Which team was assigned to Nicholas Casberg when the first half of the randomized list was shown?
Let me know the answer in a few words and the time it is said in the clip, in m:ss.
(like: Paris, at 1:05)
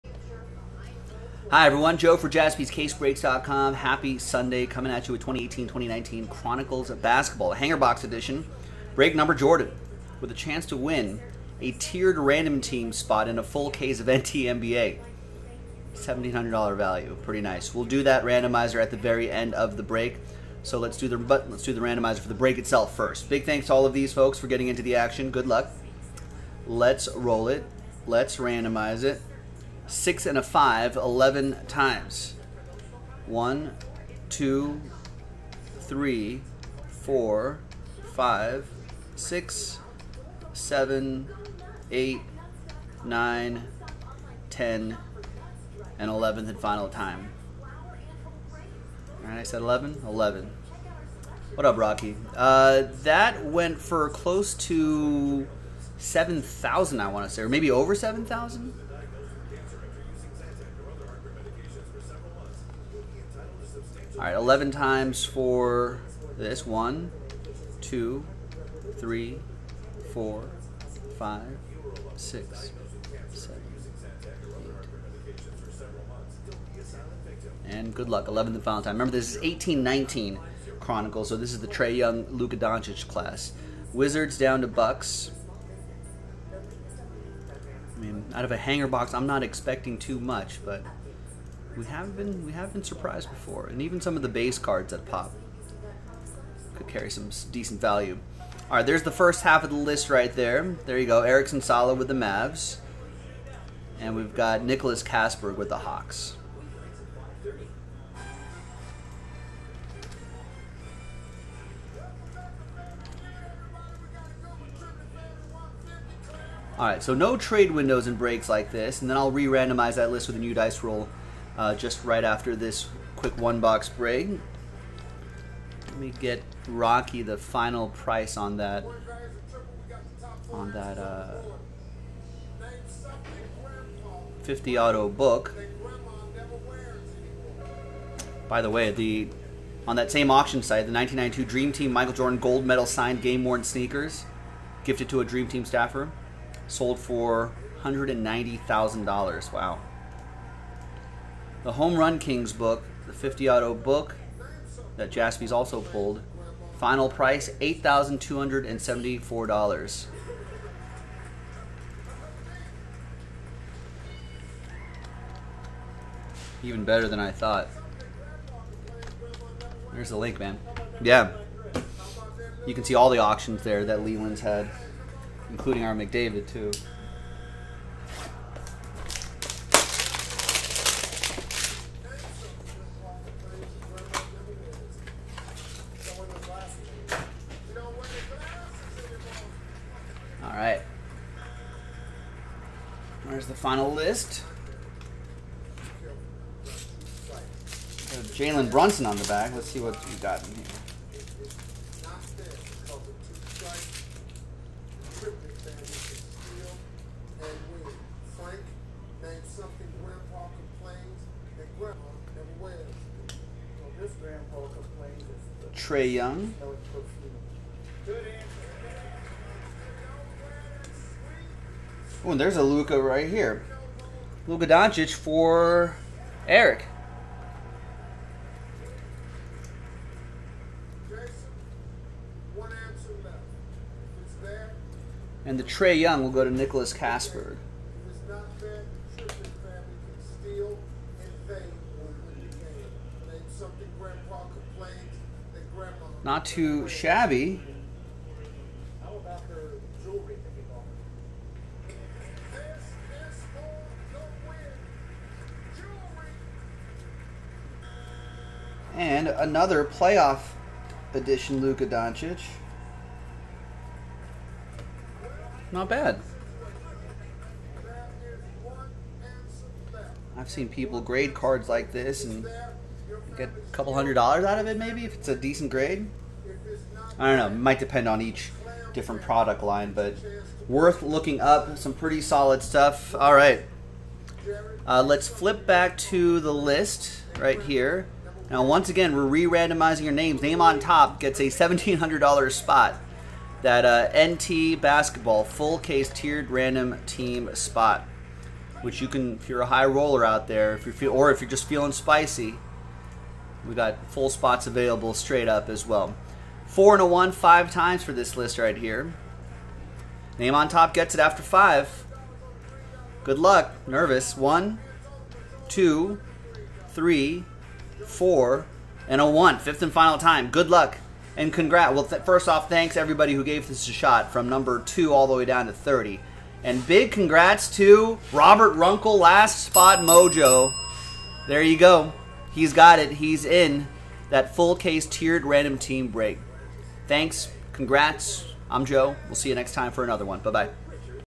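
Hawks, at 1:45.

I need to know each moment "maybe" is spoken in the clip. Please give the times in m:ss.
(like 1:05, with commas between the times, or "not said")
0:57, 4:34.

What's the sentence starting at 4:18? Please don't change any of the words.
And another playoff edition Luka Doncic.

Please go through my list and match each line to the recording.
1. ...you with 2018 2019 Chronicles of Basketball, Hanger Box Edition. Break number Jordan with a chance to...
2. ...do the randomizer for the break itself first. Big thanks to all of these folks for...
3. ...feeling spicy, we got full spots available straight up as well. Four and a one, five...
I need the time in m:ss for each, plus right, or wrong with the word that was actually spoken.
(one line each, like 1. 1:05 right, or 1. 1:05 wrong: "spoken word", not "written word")
1. 0:05 right
2. 0:21 right
3. 5:01 right.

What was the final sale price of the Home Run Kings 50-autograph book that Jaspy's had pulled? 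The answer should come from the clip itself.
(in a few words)
$8,274.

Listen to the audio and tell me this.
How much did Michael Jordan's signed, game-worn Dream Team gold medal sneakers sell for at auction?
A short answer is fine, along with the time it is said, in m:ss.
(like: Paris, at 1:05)
$190,000, at 2:27.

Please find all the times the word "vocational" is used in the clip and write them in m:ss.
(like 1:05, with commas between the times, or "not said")
not said.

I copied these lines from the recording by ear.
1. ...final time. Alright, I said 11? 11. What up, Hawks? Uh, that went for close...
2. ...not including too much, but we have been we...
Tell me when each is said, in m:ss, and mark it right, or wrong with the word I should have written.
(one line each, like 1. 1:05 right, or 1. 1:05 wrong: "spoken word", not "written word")
1. 0:46 wrong: "Rocky", not "Hawks"
2. 1:29 wrong: "expecting", not "including".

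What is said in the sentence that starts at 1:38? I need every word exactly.
All right, there's the first half of the list right there.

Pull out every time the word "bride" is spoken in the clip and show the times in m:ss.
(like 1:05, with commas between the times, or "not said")
not said.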